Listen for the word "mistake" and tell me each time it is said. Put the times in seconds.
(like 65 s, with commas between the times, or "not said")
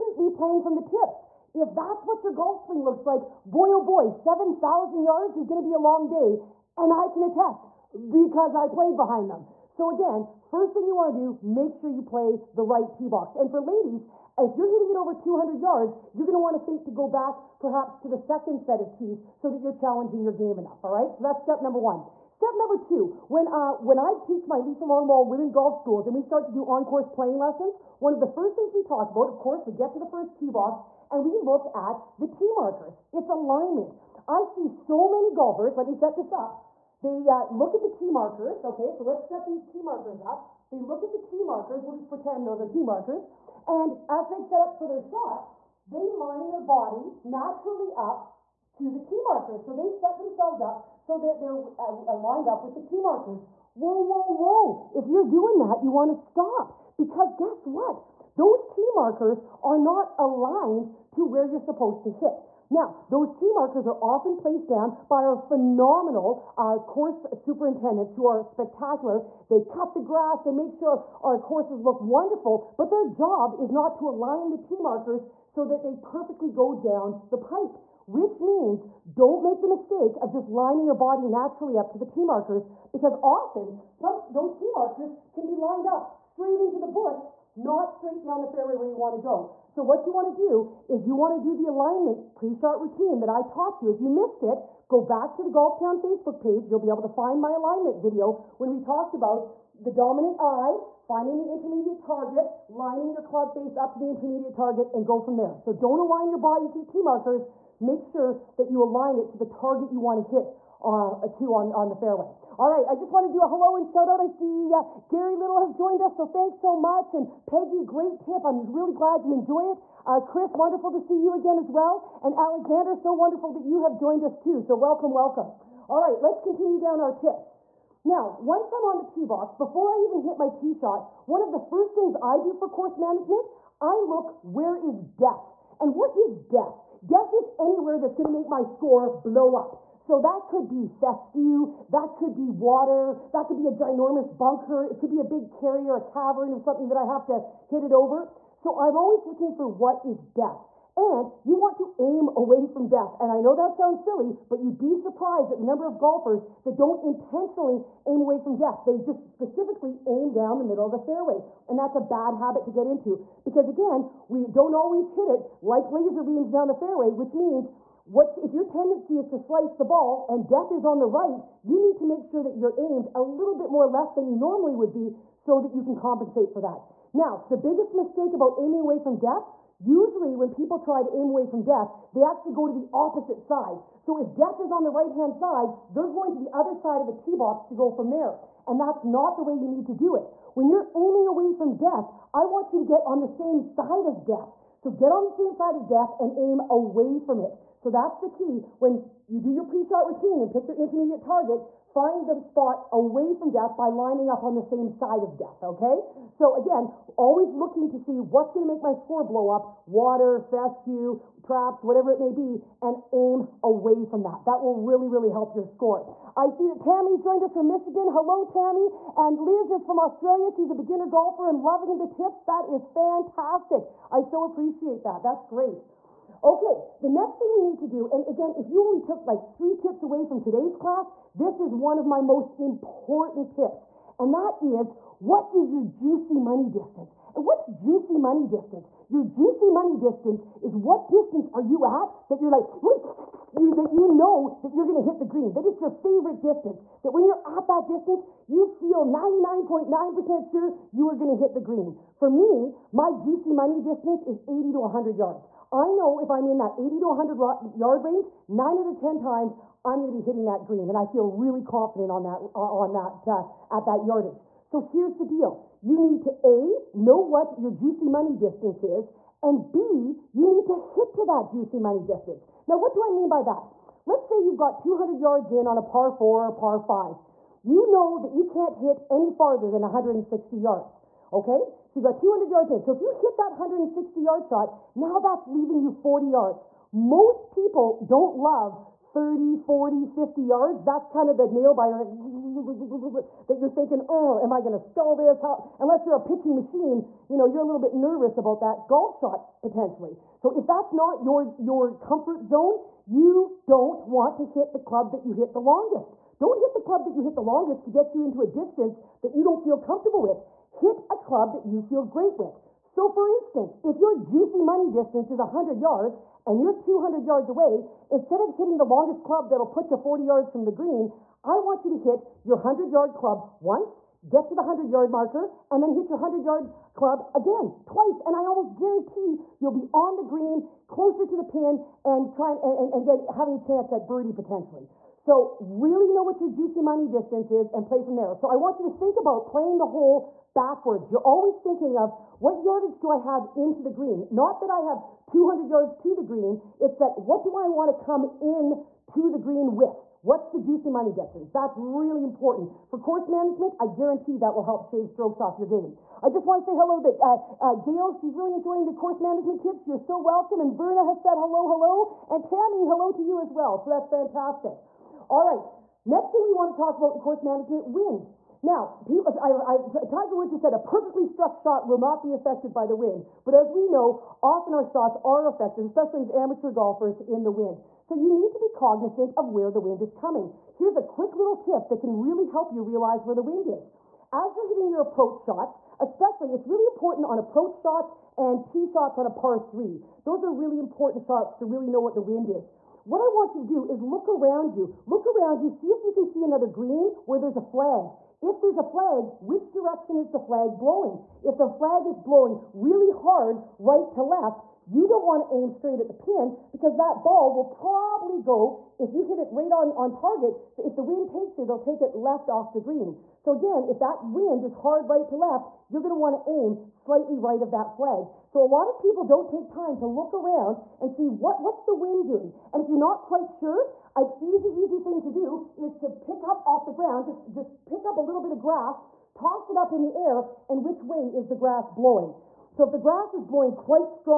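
79 s, 177 s.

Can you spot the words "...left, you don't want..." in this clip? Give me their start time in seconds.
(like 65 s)
404 s.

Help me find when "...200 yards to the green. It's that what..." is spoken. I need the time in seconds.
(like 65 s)
345 s.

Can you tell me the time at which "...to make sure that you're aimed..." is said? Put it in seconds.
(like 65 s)
171 s.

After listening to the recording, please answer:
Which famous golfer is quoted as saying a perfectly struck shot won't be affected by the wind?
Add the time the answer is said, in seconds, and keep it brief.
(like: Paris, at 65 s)
Tiger Woods, at 370 s.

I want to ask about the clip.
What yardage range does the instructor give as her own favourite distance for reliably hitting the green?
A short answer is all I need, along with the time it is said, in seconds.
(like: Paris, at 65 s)
80 to 100 yards, at 254 s.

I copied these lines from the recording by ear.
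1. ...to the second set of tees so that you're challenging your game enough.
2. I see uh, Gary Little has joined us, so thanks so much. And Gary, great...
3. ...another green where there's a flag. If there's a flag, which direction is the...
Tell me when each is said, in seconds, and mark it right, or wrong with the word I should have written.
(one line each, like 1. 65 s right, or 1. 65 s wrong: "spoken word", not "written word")
1. 17 s right
2. 114 s wrong: "Peggy", not "Gary"
3. 396 s right.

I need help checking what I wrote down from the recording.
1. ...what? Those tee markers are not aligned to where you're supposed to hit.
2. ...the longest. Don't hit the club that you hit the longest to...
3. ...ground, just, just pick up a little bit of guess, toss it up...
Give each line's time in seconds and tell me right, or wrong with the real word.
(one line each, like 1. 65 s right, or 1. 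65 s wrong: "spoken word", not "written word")
1. 57 s right
2. 305 s right
3. 426 s wrong: "grass", not "guess".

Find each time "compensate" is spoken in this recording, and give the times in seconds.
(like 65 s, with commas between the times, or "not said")
175 s.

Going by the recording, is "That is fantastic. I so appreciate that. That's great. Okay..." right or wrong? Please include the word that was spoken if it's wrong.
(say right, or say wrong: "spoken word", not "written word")
right.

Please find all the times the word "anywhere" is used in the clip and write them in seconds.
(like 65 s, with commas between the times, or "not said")
137 s.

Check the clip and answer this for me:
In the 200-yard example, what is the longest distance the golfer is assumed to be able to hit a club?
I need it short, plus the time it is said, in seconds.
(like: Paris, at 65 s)
160 yards, at 279 s.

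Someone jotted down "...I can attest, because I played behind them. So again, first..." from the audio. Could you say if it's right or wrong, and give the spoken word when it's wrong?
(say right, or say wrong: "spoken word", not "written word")
right.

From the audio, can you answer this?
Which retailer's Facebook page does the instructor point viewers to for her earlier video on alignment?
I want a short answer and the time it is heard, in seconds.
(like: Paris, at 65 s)
Golf Town, at 95 s.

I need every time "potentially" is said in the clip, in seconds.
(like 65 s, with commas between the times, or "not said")
299 s, 334 s.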